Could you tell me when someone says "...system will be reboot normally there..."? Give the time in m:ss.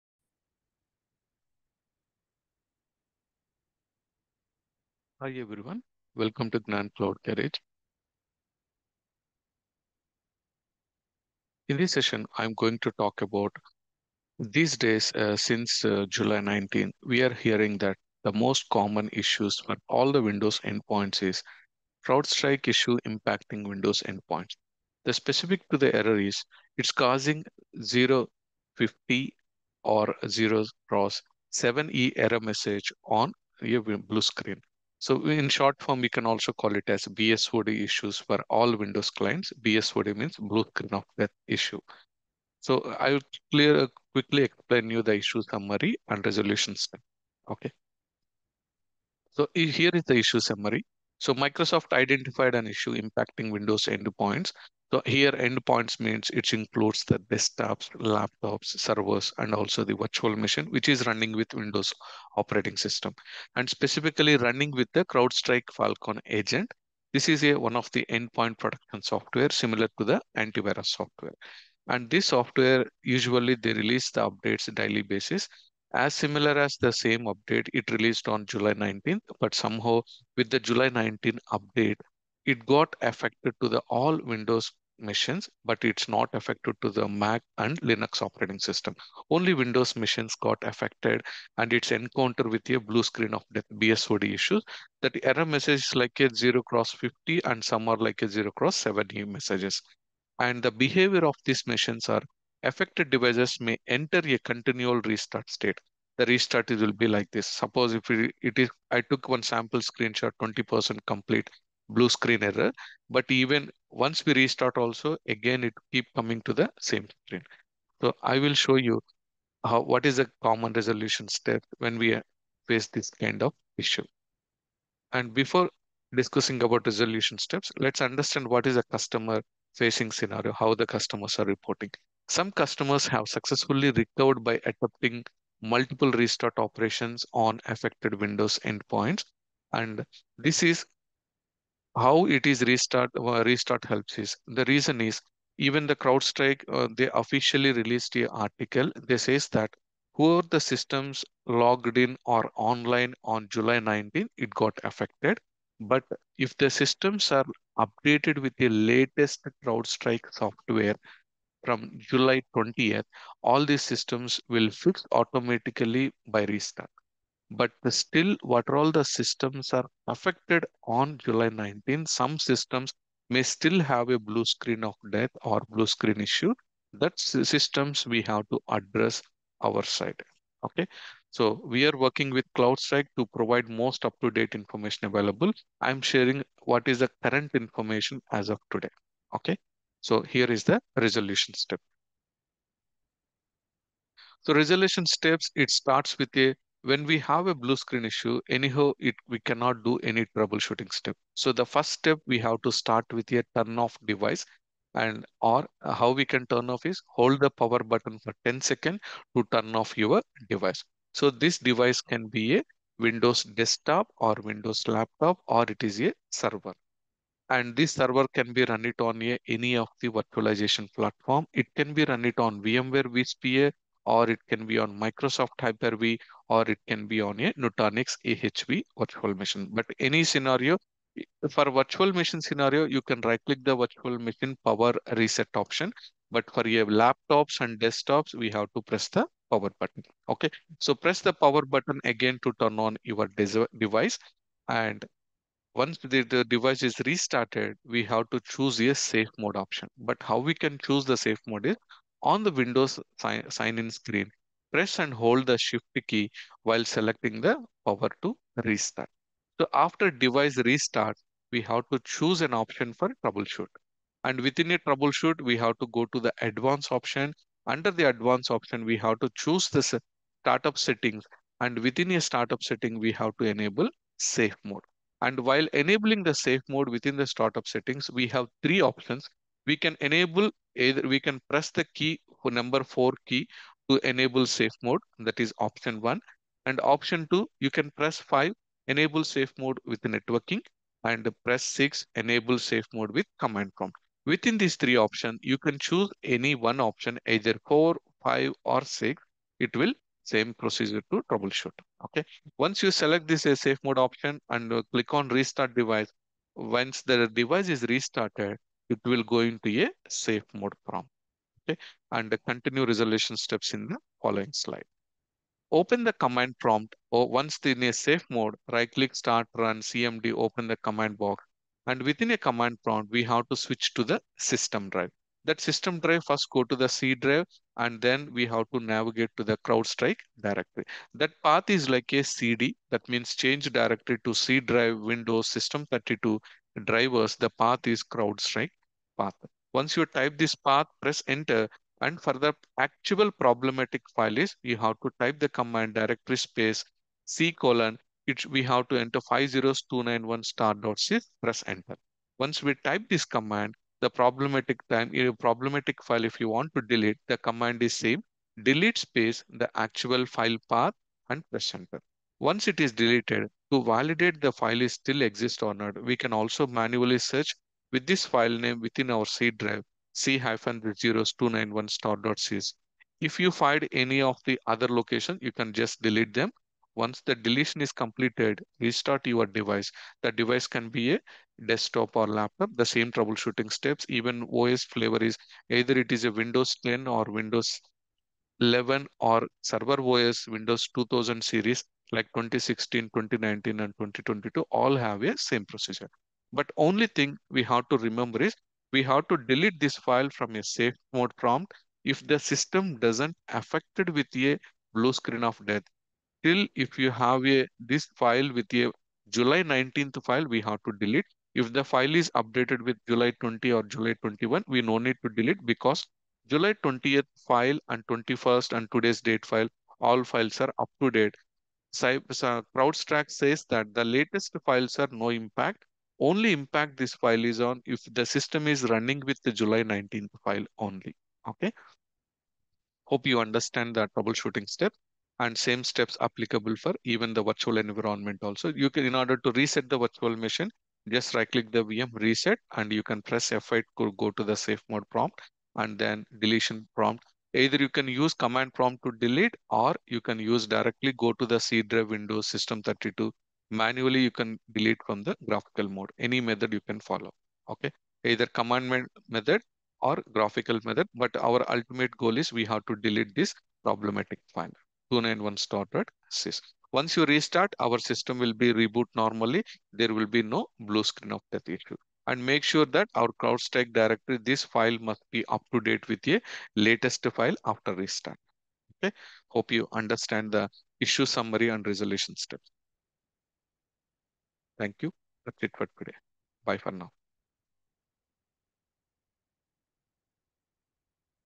7:48.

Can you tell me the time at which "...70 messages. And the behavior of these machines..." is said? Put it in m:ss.
1:38.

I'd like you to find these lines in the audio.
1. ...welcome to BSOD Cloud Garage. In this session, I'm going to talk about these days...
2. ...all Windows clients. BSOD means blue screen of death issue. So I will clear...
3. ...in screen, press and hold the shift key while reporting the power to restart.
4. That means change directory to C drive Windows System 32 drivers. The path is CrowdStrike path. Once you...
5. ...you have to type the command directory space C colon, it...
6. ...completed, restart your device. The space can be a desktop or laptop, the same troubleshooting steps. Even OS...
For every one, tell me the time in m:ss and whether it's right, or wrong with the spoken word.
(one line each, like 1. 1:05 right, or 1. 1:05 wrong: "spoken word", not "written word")
1. 0:06 wrong: "Gnan", not "BSOD"
2. 0:38 right
3. 4:13 wrong: "selecting", not "reporting"
4. 5:32 right
5. 5:44 right
6. 6:17 wrong: "device", not "space".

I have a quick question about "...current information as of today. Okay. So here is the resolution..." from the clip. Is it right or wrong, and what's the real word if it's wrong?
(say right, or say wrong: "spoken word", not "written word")
right.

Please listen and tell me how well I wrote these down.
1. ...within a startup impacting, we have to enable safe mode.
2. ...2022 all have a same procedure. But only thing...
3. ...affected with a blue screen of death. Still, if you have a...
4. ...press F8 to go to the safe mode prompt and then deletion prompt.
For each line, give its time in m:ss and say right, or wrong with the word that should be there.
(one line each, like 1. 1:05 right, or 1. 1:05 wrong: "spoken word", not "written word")
1. 4:31 wrong: "setting", not "impacting"
2. 6:33 right
3. 6:43 right
4. 7:23 right.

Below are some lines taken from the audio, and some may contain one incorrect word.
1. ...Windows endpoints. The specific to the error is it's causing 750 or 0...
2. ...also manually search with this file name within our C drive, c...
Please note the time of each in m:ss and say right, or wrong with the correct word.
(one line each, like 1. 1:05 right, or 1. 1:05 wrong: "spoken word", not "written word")
1. 0:23 wrong: "050", not "750"
2. 6:06 right.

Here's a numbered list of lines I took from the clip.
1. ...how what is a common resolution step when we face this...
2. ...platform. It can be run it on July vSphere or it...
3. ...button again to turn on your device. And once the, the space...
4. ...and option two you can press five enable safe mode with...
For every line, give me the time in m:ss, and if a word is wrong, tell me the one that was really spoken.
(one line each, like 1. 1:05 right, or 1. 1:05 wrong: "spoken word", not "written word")
1. 1:59 right
2. 3:40 wrong: "VMware", not "July"
3. 4:01 wrong: "device", not "space"
4. 4:46 right.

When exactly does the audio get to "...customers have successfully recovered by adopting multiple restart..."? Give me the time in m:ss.
2:12.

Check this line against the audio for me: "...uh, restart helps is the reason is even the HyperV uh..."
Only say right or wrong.
wrong.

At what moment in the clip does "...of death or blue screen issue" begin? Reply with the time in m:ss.
2:54.